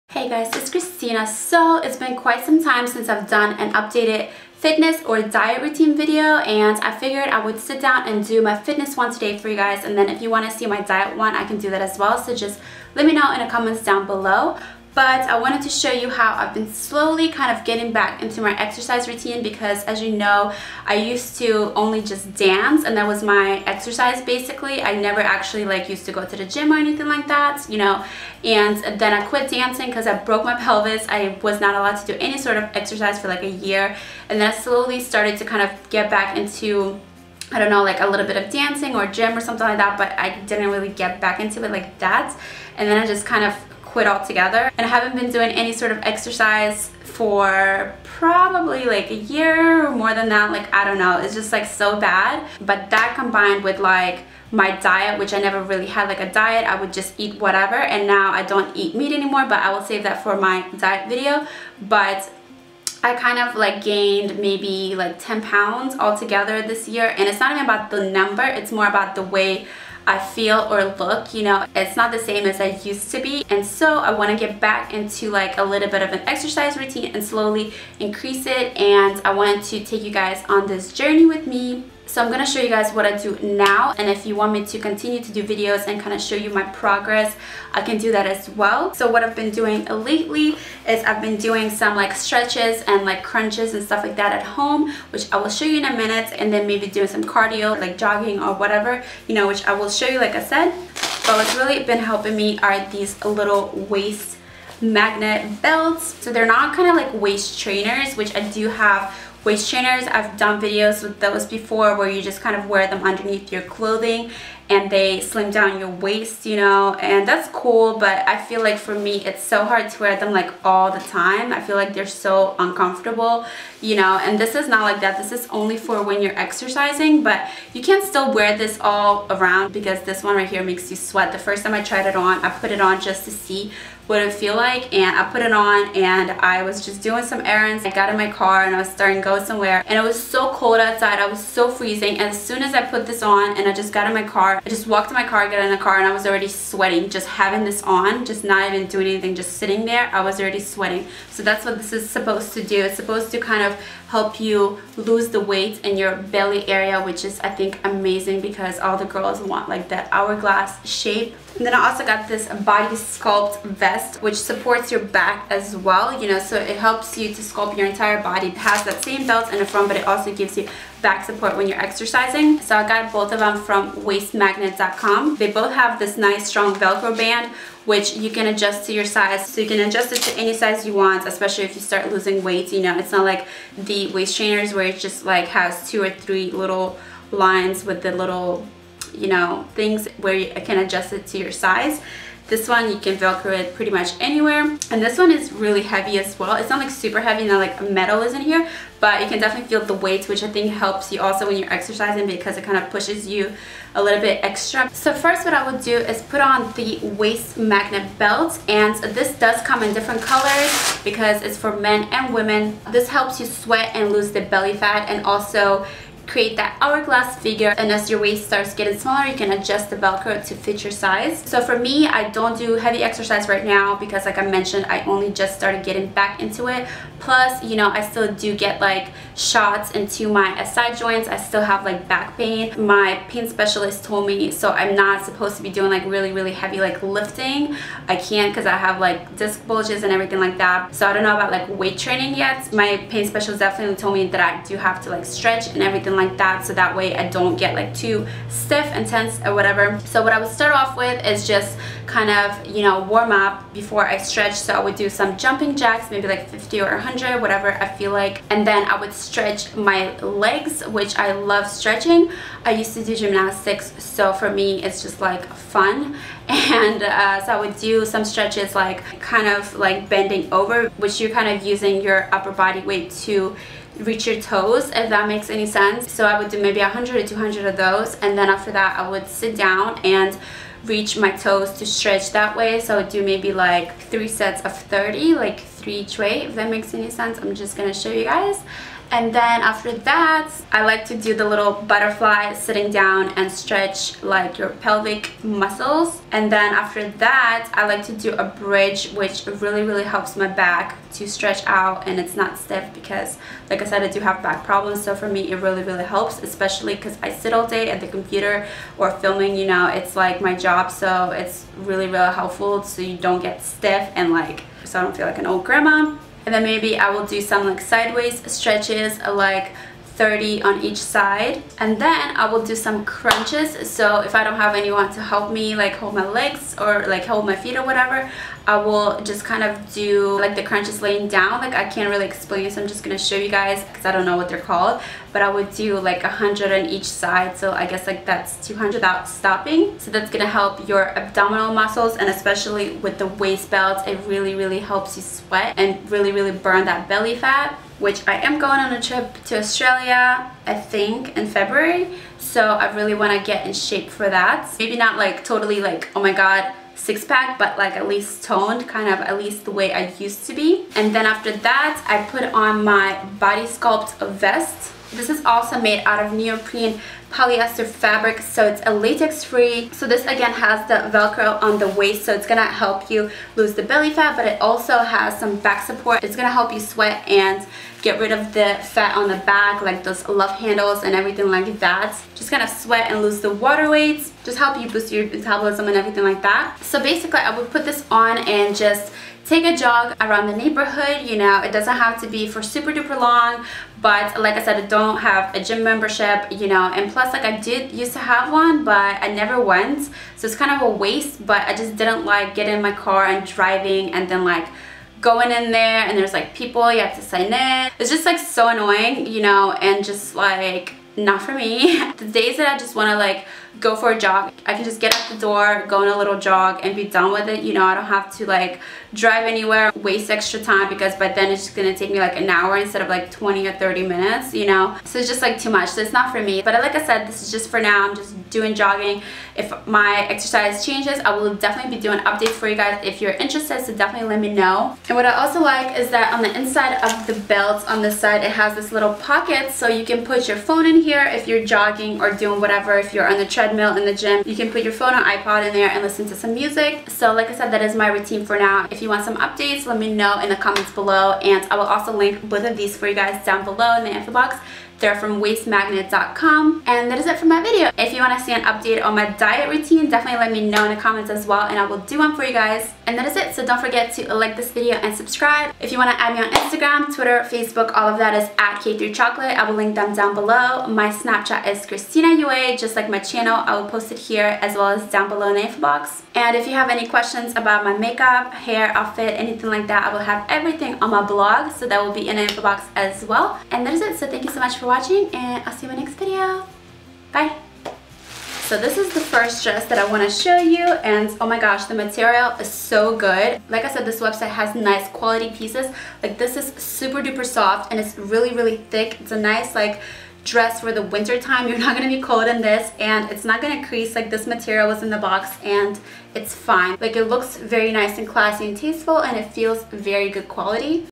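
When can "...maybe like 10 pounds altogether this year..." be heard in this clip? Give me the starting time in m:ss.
1:04.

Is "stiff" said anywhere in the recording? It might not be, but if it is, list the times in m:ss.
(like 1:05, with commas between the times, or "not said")
4:08, 5:02, 5:13.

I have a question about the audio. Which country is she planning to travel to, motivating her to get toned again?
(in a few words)
Australia.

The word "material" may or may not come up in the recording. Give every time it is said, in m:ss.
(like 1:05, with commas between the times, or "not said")
8:11, 8:24.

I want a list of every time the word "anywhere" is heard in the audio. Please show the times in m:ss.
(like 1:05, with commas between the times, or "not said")
3:14, 6:59.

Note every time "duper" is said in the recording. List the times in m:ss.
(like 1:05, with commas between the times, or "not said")
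6:32, 8:17.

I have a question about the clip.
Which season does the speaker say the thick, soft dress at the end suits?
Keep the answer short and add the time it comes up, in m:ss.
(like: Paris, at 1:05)
Winter, at 8:21.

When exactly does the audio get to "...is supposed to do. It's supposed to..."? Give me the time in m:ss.
2:31.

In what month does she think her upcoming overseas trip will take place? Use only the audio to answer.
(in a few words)
February.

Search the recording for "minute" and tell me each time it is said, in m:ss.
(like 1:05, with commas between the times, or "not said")
1:35, 7:04.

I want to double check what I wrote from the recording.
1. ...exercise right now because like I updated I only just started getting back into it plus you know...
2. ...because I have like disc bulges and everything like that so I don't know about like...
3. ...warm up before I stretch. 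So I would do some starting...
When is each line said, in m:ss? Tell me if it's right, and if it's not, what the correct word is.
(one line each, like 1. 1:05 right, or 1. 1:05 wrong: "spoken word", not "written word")
1. 3:43 wrong: "mentioned", not "updated"
2. 3:58 right
3. 4:13 wrong: "jumping", not "starting".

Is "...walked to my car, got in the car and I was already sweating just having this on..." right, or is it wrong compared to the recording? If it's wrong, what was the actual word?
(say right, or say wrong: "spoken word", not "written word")
right.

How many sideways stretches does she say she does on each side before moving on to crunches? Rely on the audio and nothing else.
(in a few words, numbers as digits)
30.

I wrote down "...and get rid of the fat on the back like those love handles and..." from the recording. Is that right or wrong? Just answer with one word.
right.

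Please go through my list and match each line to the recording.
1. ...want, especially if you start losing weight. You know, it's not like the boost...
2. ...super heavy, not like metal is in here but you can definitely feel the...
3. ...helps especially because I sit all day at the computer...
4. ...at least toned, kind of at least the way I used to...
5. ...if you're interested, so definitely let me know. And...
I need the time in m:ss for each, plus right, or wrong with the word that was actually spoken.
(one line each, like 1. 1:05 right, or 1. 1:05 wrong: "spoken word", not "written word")
1. 3:00 wrong: "waist", not "boost"
2. 3:16 right
3. 5:06 right
4. 5:57 right
5. 7:13 right.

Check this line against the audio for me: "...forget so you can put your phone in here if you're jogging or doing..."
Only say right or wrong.
wrong.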